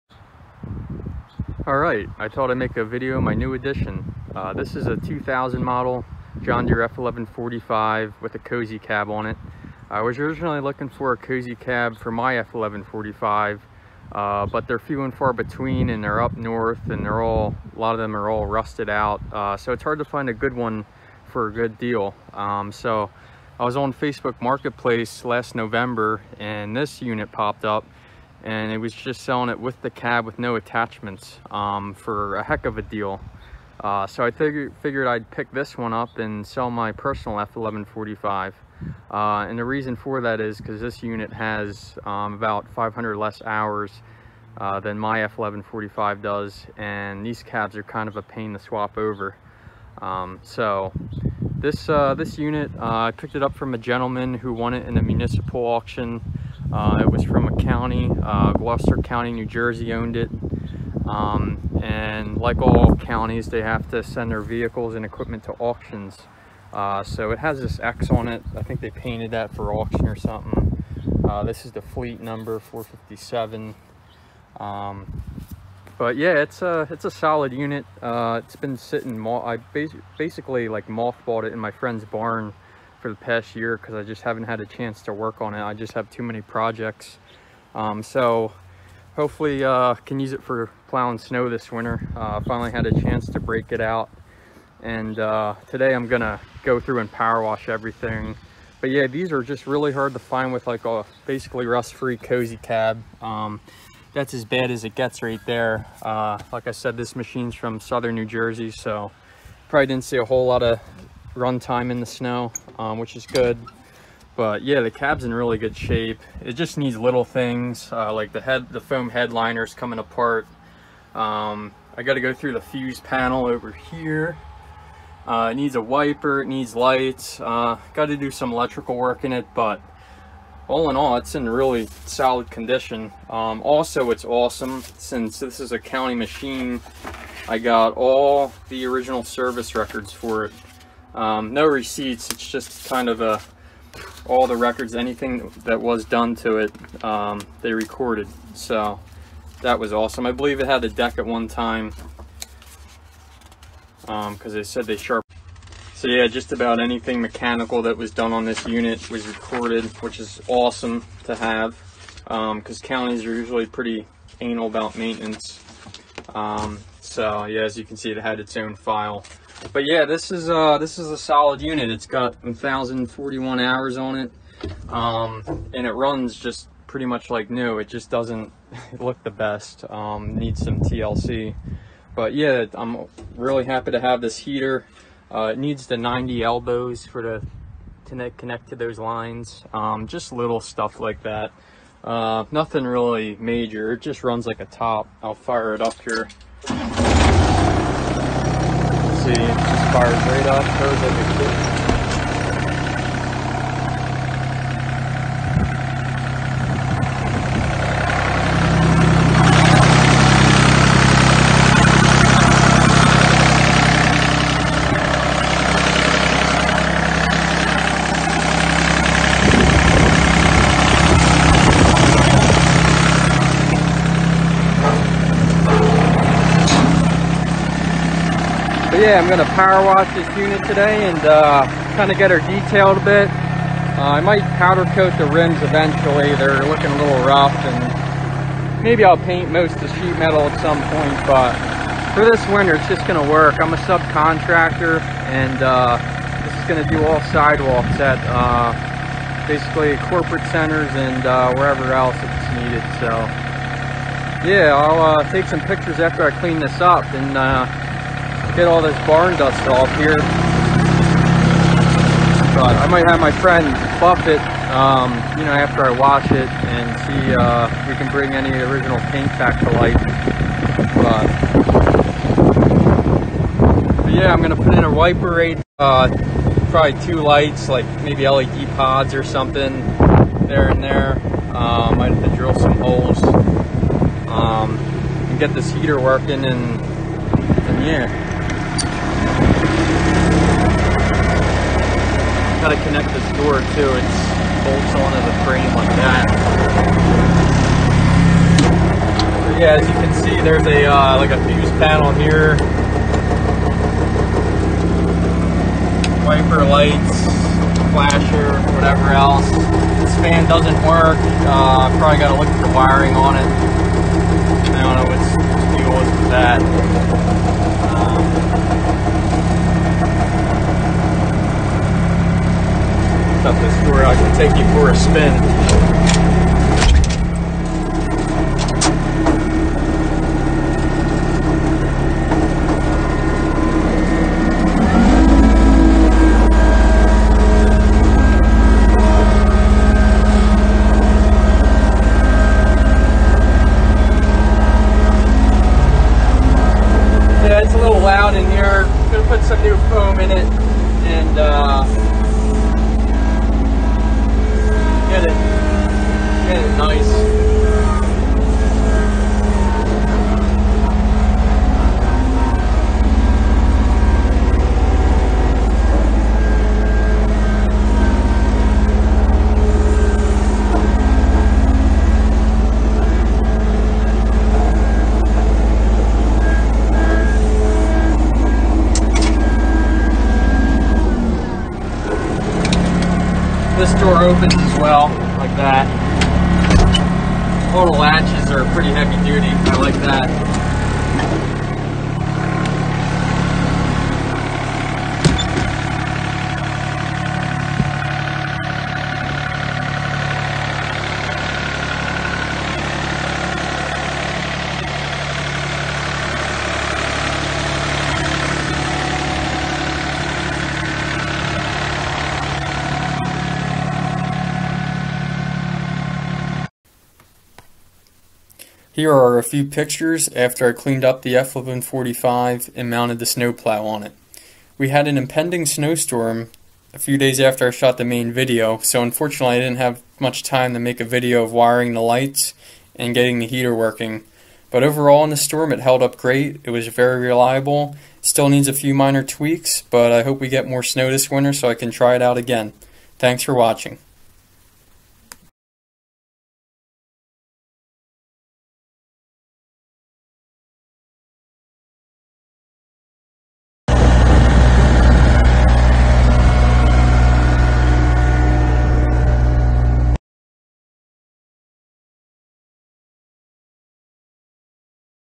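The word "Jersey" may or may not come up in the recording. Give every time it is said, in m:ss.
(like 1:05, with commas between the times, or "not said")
0:59, 1:48.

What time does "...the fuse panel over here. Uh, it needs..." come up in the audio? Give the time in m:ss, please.
2:02.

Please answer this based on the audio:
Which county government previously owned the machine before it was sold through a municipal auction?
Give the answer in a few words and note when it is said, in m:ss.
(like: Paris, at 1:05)
Gloucester County, at 0:58.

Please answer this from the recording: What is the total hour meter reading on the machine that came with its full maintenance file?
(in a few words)
1,041.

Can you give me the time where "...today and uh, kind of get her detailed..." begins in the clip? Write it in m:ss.
3:50.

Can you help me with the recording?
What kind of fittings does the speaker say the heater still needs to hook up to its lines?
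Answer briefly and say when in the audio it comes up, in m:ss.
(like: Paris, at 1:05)
90 elbows, at 3:05.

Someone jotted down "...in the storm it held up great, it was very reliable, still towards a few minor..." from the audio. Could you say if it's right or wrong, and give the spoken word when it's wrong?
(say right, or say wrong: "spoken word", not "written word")
wrong: "needs", not "towards".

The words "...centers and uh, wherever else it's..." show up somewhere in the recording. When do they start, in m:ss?
4:10.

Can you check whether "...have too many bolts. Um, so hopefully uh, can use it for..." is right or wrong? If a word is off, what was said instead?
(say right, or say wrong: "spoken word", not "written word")
wrong: "projects", not "bolts".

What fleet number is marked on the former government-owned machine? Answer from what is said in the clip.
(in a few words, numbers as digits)
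457.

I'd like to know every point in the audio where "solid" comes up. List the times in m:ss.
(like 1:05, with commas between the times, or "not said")
1:17, 2:12, 2:51.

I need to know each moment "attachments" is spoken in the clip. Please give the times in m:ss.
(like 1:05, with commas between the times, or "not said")
0:30.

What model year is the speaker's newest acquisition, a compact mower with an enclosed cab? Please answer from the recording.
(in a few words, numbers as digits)
2000.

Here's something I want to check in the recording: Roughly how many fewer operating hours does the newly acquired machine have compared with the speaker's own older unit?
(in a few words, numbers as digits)
500.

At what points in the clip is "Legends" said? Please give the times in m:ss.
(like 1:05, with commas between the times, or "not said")
not said.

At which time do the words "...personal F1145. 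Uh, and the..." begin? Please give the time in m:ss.
0:36.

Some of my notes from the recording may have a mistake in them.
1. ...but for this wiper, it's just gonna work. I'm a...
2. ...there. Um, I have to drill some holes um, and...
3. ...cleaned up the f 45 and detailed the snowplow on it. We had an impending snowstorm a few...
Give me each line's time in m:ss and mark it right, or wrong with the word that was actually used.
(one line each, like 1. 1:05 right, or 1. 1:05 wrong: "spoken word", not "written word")
1. 4:01 wrong: "winter", not "wiper"
2. 4:40 right
3. 7:00 wrong: "mounted", not "detailed".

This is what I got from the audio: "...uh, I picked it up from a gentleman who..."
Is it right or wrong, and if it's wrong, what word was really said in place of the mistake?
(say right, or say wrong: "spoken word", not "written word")
right.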